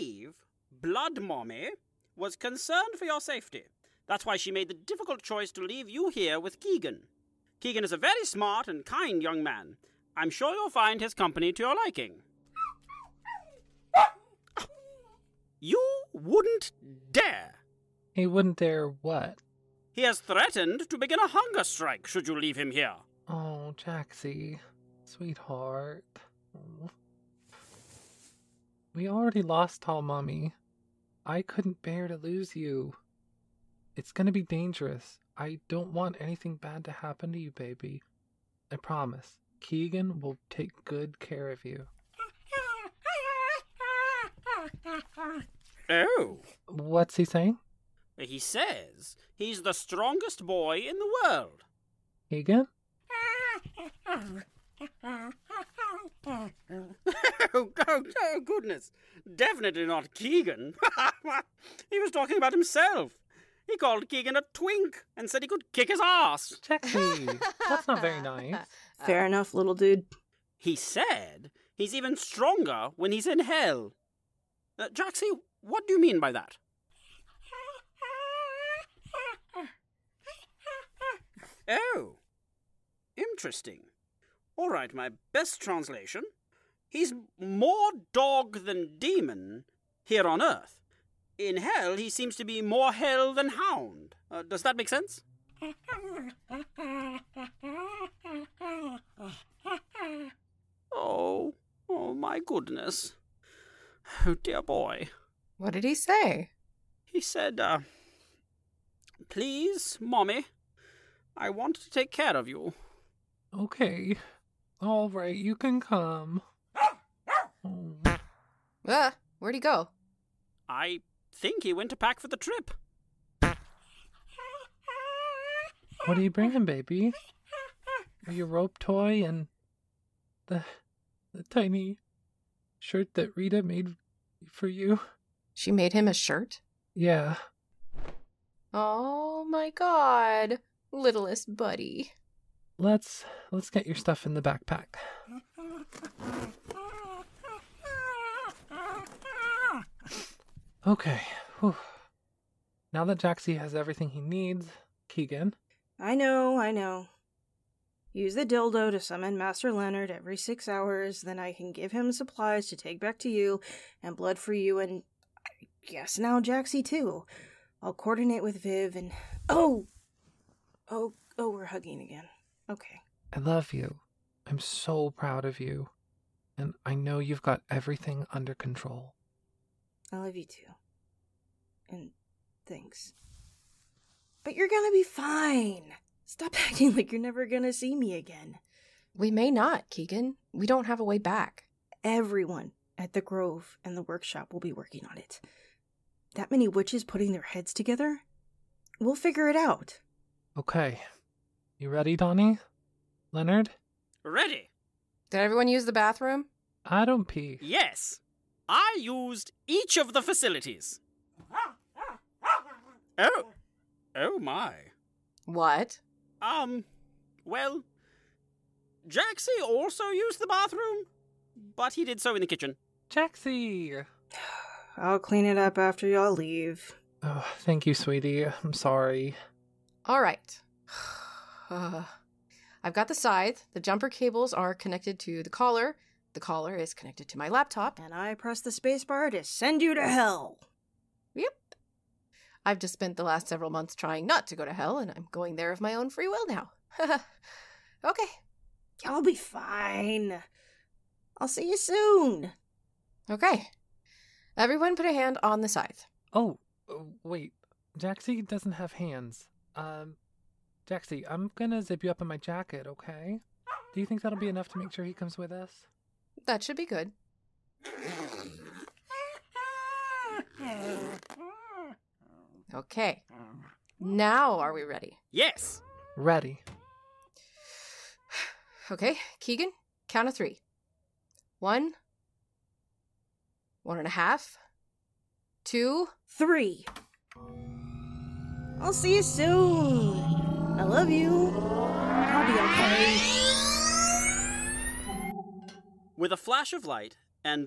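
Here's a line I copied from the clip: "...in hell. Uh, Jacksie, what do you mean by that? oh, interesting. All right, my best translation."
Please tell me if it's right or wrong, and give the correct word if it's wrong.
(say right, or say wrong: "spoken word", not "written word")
right.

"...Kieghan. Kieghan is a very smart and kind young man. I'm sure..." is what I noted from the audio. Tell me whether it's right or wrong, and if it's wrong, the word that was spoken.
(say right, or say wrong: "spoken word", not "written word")
right.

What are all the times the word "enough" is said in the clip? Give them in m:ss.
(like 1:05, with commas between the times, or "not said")
1:09, 4:24.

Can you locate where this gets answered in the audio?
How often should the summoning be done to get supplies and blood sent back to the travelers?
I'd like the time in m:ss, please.
2:40.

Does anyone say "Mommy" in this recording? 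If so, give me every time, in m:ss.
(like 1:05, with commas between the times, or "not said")
0:01, 0:30, 1:49.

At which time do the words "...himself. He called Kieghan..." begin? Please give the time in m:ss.
1:02.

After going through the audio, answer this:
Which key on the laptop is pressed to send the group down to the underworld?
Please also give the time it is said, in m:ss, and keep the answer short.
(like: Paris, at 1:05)
spacebar, at 3:58.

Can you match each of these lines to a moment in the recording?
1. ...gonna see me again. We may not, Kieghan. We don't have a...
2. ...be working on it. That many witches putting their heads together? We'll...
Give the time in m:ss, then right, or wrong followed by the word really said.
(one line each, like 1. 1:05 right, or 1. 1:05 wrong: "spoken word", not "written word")
1. 3:07 right
2. 3:14 right.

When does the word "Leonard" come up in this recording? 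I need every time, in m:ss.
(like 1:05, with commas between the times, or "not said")
2:39, 3:23.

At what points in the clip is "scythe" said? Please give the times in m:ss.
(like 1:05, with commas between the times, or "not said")
3:53, 4:15.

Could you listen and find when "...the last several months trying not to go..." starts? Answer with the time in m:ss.
4:03.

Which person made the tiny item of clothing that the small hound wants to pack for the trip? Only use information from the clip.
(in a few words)
Rita.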